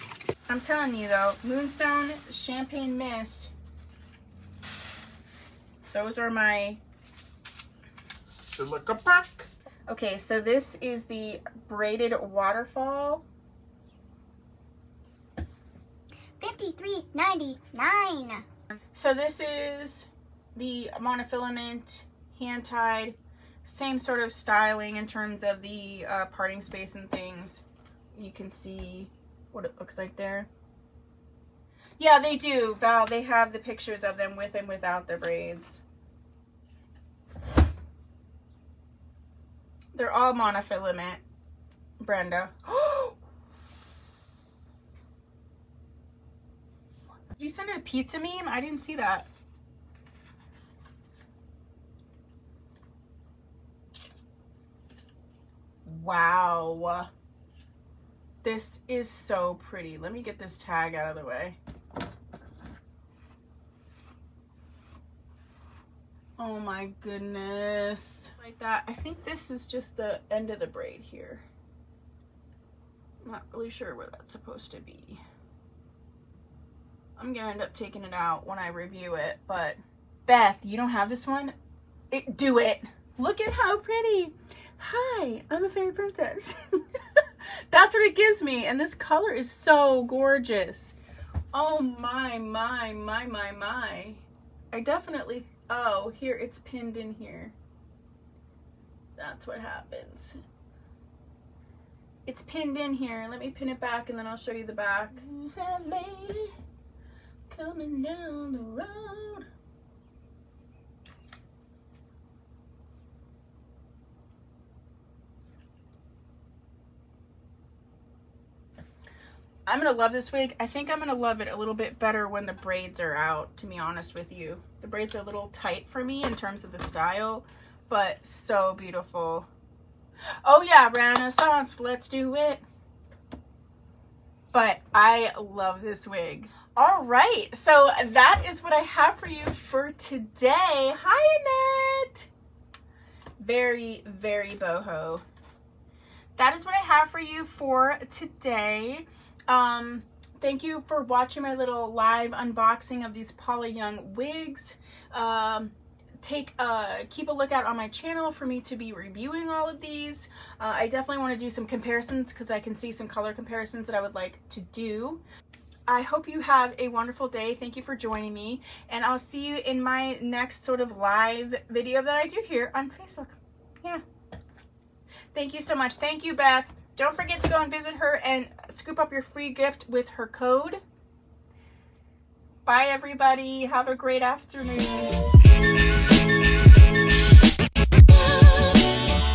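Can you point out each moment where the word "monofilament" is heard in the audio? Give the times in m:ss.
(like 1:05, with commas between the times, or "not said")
0:20, 0:40.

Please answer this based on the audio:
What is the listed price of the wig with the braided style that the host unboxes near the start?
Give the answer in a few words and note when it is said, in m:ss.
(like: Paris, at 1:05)
$53.99, at 0:16.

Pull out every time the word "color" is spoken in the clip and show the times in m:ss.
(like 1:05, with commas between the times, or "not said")
1:28, 2:43.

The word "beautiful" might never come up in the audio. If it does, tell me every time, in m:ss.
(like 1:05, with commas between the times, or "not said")
2:08.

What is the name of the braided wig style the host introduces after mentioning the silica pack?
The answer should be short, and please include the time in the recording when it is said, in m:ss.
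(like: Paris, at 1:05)
Braided Waterfall, at 0:11.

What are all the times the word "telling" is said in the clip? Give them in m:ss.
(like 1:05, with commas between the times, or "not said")
0:00.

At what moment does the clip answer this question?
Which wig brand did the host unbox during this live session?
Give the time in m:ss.
2:33.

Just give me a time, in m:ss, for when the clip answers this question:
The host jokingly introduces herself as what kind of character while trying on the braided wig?
1:25.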